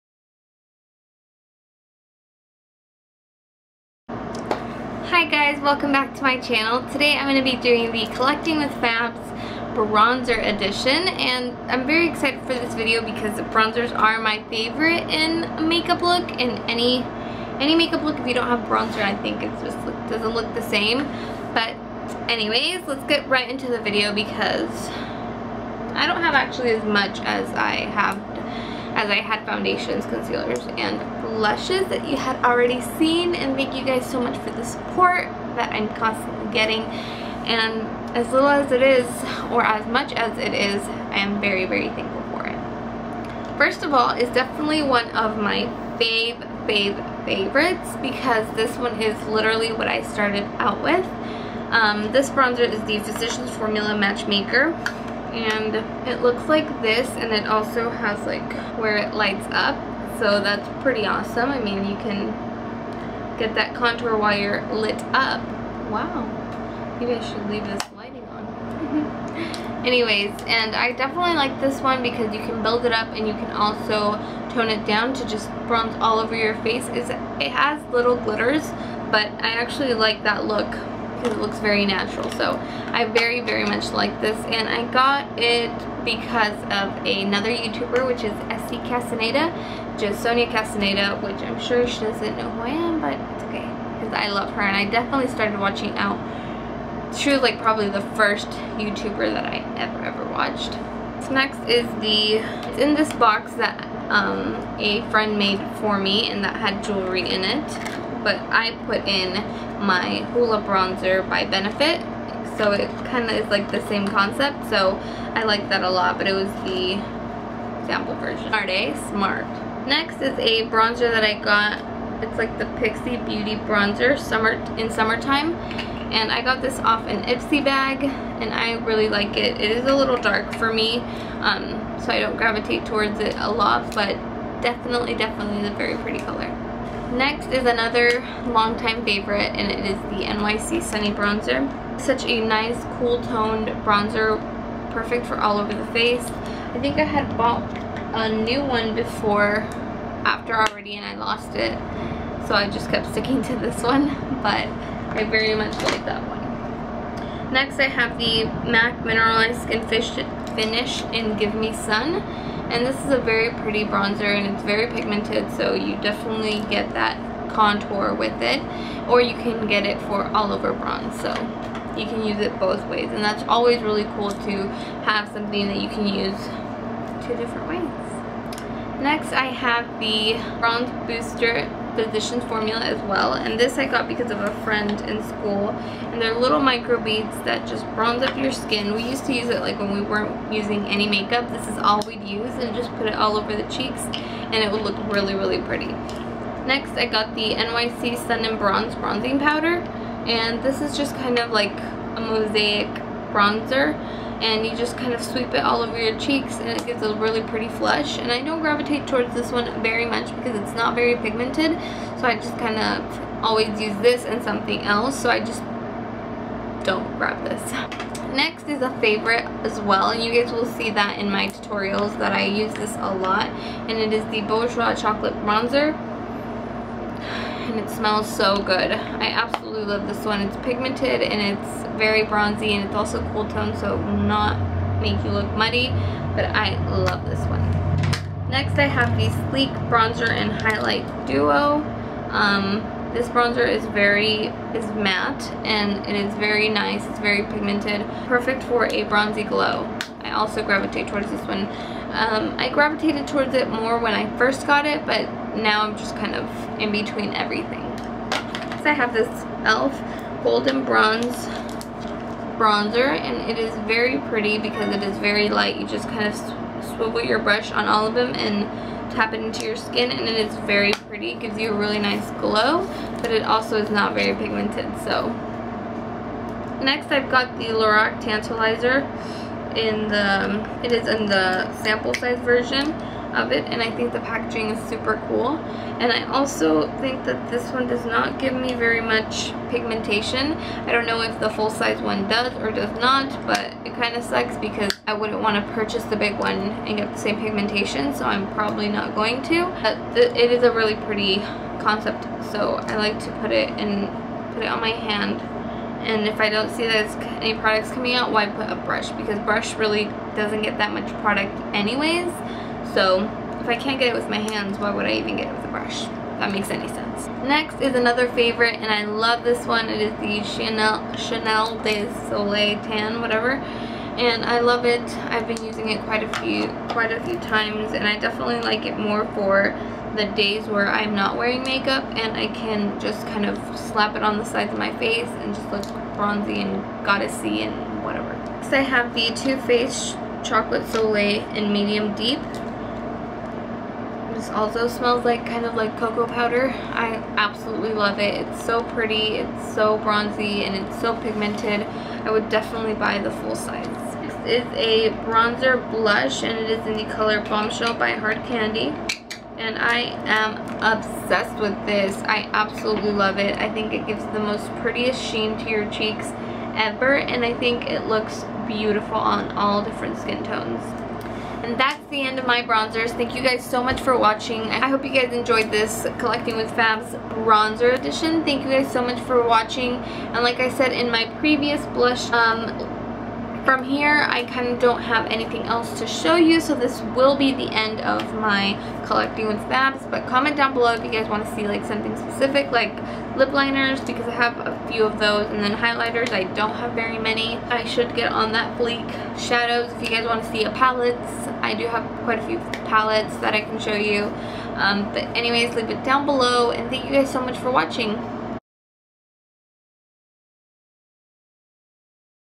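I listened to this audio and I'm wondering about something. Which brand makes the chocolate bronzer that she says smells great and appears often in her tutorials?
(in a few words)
Bourjois.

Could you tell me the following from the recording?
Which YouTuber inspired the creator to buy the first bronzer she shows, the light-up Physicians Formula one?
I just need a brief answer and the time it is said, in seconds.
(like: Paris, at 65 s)
Sonia Castaneda, at 90 s.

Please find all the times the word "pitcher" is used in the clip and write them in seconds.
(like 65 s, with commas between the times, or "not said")
not said.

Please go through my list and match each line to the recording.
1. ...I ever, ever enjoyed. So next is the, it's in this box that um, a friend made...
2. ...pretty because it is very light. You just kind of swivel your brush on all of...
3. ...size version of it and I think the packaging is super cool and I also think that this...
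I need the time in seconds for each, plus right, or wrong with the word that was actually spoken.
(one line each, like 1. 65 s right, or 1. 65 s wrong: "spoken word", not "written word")
1. 99 s wrong: "watched", not "enjoyed"
2. 264 s right
3. 282 s right.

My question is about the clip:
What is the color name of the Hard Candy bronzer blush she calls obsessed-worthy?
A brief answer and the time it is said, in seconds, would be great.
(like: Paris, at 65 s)
Bombshell, at 357 s.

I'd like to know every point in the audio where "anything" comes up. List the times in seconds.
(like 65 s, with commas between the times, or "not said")
385 s.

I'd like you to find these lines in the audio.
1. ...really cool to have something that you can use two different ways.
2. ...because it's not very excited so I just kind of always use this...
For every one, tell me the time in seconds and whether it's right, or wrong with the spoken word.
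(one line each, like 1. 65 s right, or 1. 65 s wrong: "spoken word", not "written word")
1. 173 s right
2. 210 s wrong: "pigmented", not "excited".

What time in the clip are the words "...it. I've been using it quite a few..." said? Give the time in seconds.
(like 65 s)
324 s.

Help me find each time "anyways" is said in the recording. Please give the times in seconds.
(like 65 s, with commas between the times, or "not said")
22 s, 69 s, 311 s, 405 s.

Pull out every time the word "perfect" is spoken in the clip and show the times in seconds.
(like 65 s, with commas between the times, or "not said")
144 s, 248 s.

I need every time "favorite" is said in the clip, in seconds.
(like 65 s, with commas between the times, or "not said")
14 s, 47 s, 139 s, 218 s, 318 s.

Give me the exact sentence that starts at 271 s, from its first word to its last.
It gives you a really nice glow but it also is not very pigmented so.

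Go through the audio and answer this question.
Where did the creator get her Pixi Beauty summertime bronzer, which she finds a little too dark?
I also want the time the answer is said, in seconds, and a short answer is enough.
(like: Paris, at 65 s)
an Ipsy bag, at 127 s.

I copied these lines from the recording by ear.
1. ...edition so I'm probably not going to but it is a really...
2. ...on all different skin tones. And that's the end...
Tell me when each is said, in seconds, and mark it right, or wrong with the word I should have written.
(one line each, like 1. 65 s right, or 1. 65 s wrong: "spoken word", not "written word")
1. 297 s wrong: "pigmentation", not "edition"
2. 369 s right.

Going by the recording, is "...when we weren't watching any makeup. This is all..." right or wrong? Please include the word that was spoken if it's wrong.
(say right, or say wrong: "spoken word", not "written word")
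wrong: "using", not "watching".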